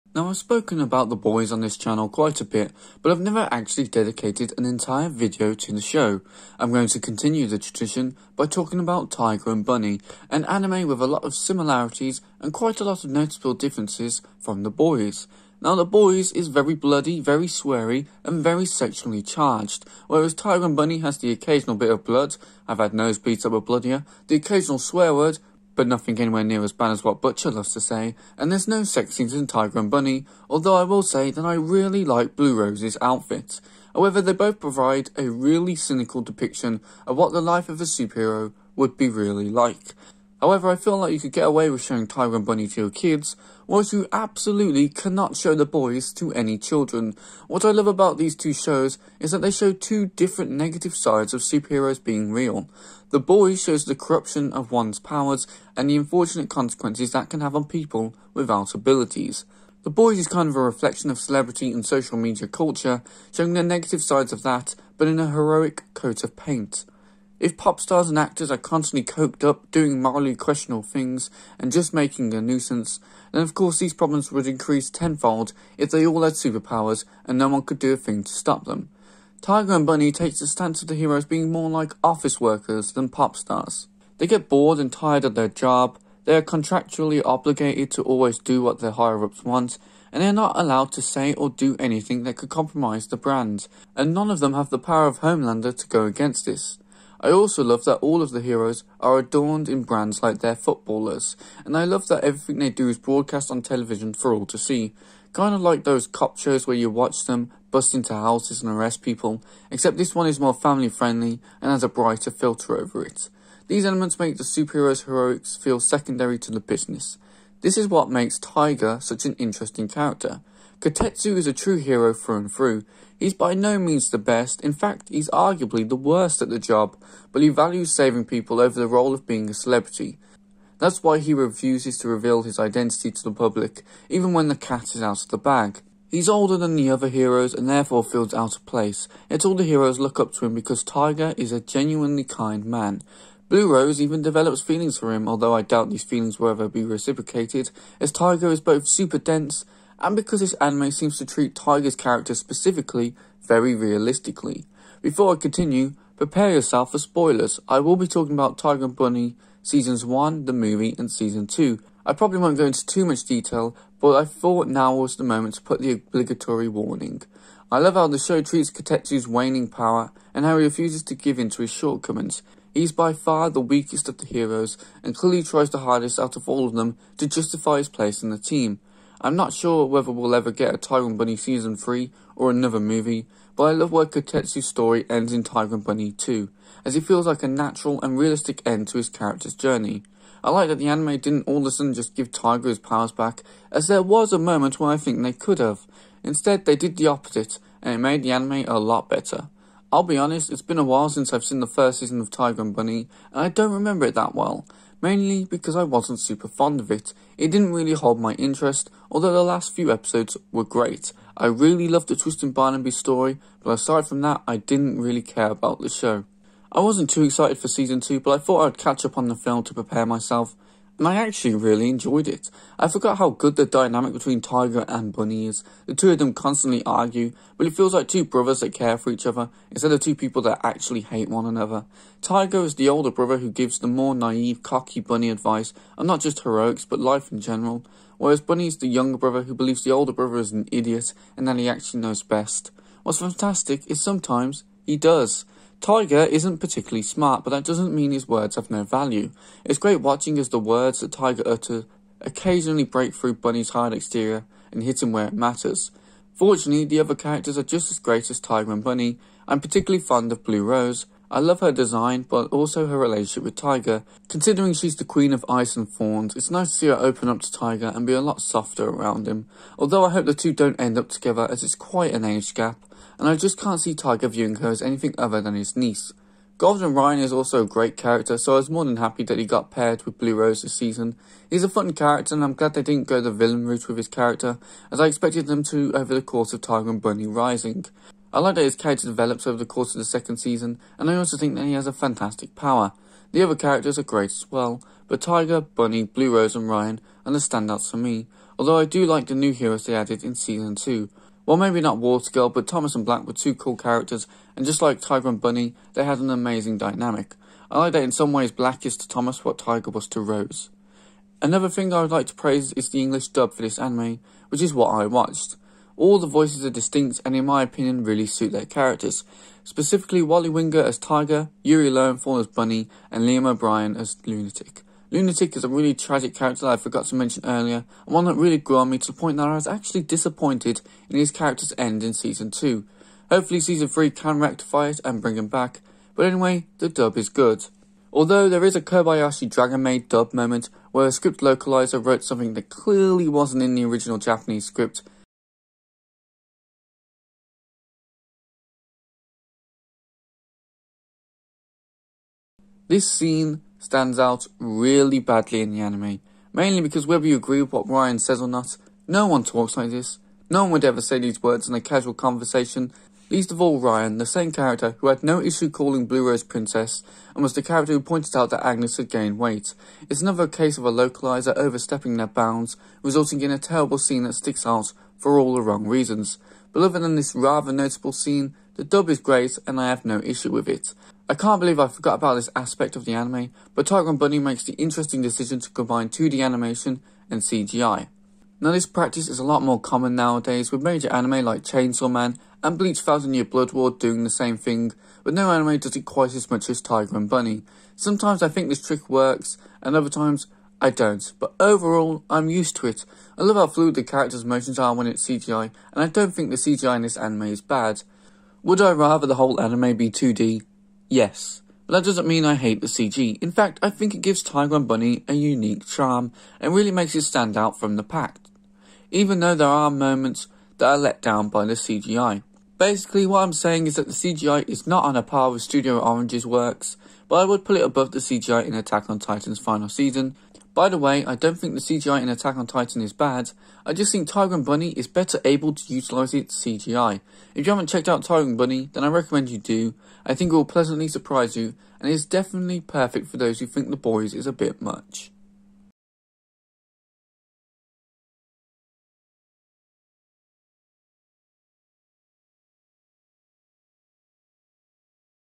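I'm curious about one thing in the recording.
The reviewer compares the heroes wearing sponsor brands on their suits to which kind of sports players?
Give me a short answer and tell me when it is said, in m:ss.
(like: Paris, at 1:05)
Footballers, at 1:40.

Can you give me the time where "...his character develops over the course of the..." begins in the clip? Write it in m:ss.
4:48.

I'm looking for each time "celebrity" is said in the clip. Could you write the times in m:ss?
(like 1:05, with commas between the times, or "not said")
1:01, 2:09.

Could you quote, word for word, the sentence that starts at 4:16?
Fortunately, the other characters are just as great as Tiger and Bunny.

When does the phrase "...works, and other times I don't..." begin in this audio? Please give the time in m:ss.
6:39.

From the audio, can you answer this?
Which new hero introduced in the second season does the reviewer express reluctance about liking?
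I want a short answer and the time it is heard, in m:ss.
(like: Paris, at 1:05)
Watergirl, at 5:01.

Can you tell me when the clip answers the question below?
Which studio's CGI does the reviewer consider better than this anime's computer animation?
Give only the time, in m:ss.
7:05.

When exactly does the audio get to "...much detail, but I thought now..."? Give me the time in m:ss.
2:43.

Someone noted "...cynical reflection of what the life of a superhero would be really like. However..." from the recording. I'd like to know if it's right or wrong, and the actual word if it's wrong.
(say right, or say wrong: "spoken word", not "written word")
wrong: "depiction", not "reflection".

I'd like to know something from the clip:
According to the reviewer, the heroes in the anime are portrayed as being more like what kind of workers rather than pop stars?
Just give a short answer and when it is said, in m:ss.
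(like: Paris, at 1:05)
Office workers, at 1:22.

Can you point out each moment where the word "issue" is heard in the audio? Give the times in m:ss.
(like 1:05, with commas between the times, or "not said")
6:05, 6:20.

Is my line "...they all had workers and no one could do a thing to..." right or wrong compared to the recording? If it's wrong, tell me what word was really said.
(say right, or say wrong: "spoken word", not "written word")
wrong: "superpowers", not "workers".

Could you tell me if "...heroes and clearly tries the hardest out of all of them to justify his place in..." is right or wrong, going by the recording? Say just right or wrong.
right.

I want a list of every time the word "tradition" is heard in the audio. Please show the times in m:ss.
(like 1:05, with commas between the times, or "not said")
0:07.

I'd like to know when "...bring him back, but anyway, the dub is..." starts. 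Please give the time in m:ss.
5:35.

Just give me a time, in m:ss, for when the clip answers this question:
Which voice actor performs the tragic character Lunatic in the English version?
5:23.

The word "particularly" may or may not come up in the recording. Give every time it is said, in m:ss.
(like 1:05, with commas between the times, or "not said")
4:06, 4:19.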